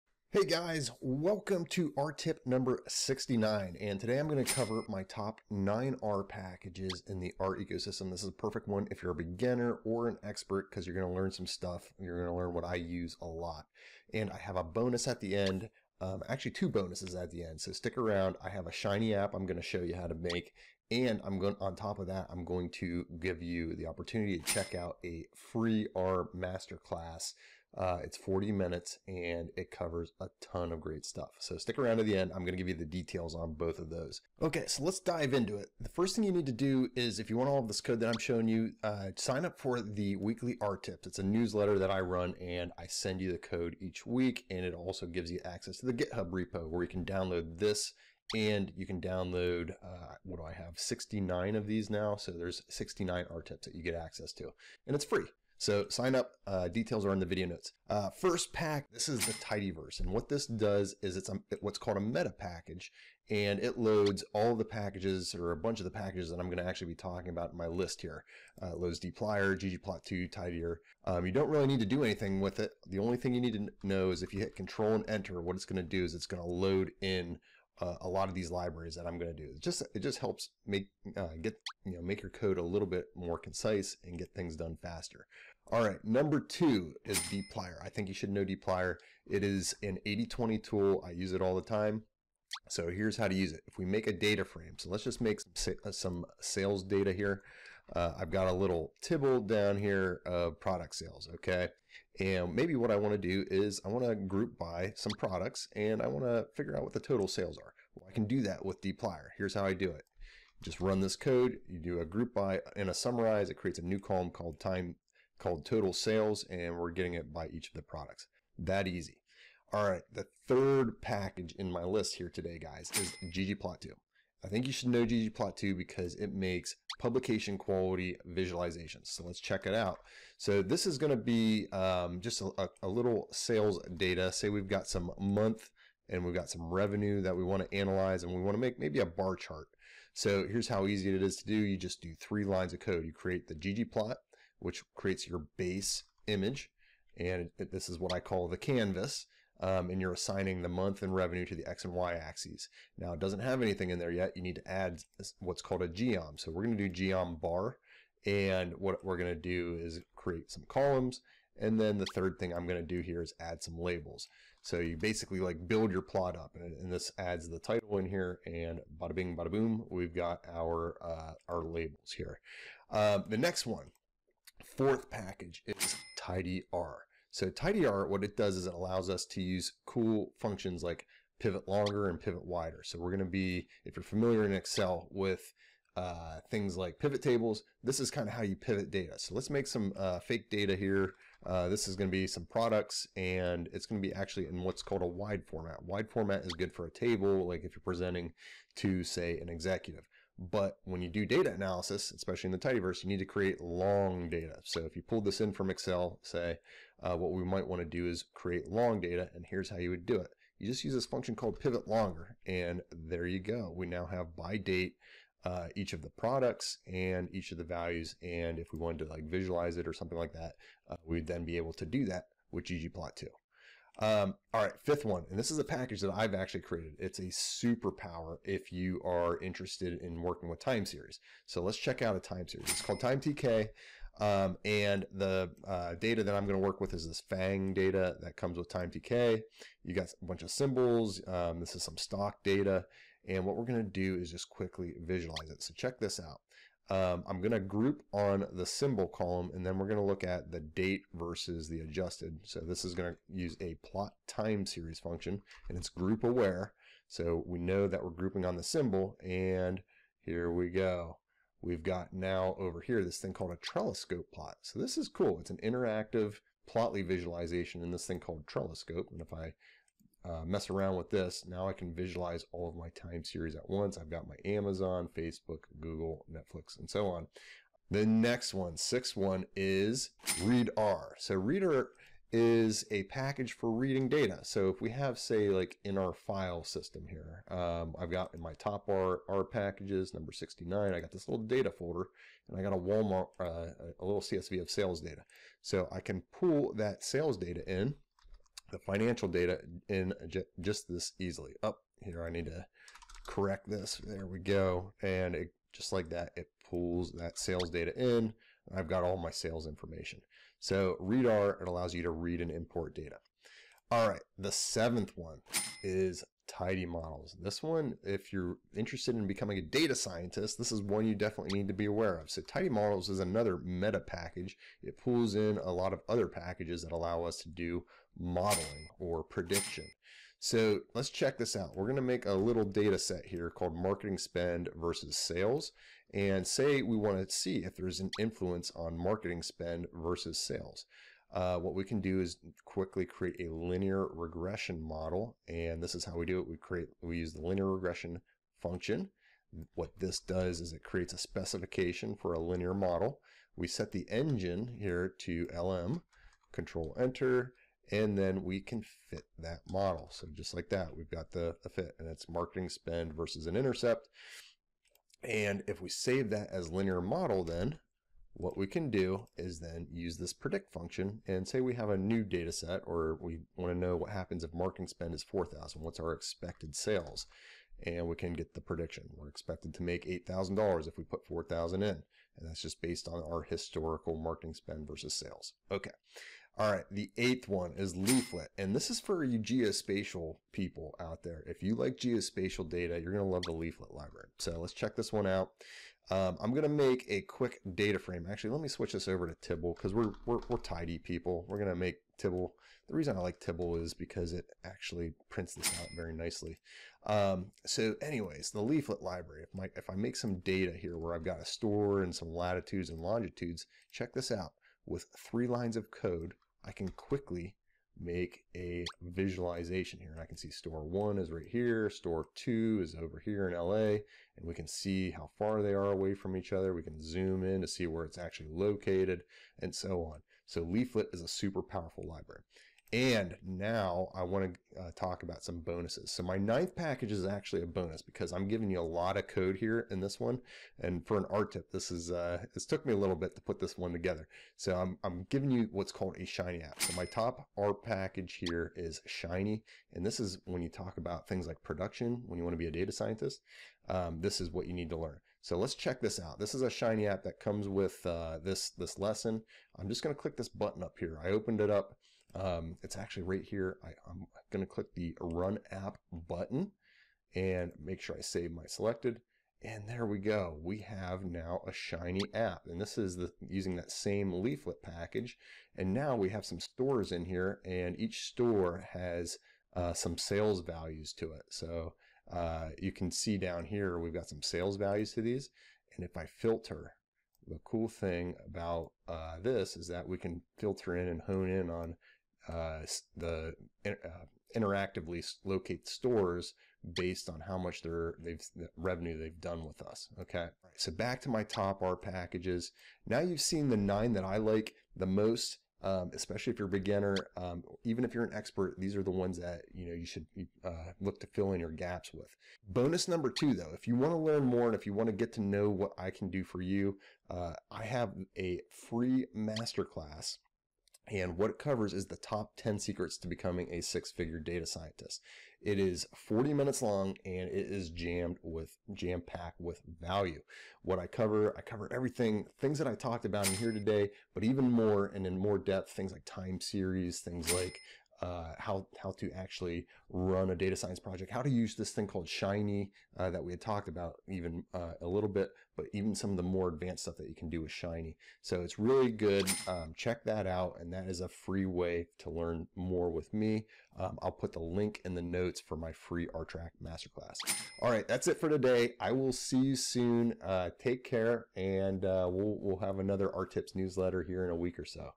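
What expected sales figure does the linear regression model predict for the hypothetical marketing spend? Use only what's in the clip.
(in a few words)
$8,000.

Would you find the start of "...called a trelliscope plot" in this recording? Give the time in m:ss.
4:23.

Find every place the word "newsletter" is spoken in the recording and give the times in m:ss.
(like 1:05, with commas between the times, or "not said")
0:41, 9:23.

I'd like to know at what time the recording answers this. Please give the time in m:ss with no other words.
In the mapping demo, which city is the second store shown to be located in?
7:03.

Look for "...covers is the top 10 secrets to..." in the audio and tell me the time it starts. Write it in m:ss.
8:41.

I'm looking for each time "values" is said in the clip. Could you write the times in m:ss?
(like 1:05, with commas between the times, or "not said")
3:37, 8:00, 8:04, 8:49.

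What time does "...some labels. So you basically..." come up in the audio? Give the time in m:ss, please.
2:43.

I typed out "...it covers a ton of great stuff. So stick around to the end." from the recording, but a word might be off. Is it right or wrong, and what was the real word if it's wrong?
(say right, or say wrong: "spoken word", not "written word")
right.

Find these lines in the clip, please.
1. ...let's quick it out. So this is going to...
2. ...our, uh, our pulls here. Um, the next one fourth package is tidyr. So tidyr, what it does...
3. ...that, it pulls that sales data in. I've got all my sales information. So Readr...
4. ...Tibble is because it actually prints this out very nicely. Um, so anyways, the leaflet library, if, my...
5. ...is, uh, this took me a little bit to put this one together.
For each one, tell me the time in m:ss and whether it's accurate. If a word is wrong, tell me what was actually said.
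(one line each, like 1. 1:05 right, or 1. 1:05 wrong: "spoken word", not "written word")
1. 2:09 wrong: "check", not "quick"
2. 2:50 wrong: "labels", not "pulls"
3. 5:06 right
4. 6:43 right
5. 7:21 right.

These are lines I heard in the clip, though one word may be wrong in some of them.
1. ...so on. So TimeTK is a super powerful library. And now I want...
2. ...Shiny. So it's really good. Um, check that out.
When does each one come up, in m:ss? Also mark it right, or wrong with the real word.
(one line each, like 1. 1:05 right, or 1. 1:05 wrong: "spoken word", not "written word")
1. 7:09 wrong: "Leaflet", not "TimeTK"
2. 9:07 right.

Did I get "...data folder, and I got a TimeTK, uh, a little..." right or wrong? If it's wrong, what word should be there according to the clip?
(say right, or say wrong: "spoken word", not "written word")
wrong: "Walmart", not "TimeTK".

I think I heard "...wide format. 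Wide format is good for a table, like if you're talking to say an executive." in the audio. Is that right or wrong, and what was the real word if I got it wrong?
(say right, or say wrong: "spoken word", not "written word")
wrong: "presenting", not "talking".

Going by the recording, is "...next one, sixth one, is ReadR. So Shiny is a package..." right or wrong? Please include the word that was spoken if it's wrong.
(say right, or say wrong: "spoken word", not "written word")
wrong: "ReadR", not "Shiny".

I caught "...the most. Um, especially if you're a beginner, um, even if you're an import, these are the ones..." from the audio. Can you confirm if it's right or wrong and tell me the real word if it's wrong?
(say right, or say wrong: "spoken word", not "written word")
wrong: "expert", not "import".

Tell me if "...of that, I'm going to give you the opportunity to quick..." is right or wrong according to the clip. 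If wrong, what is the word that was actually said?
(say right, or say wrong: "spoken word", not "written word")
wrong: "check", not "quick".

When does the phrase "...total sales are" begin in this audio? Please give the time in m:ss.
1:46.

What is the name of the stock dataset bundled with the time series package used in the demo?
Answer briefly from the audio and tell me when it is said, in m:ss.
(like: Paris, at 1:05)
FANG, at 3:57.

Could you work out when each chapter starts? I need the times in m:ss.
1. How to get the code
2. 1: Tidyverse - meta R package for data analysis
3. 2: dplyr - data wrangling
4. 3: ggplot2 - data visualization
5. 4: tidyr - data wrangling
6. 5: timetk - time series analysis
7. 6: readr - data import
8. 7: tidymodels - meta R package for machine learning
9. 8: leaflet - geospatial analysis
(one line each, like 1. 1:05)
1. 0:38
2. 0:57
3. 1:25
4. 1:59
5. 2:53
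6. 3:43
7. 4:37
8. 5:13
9. 6:27.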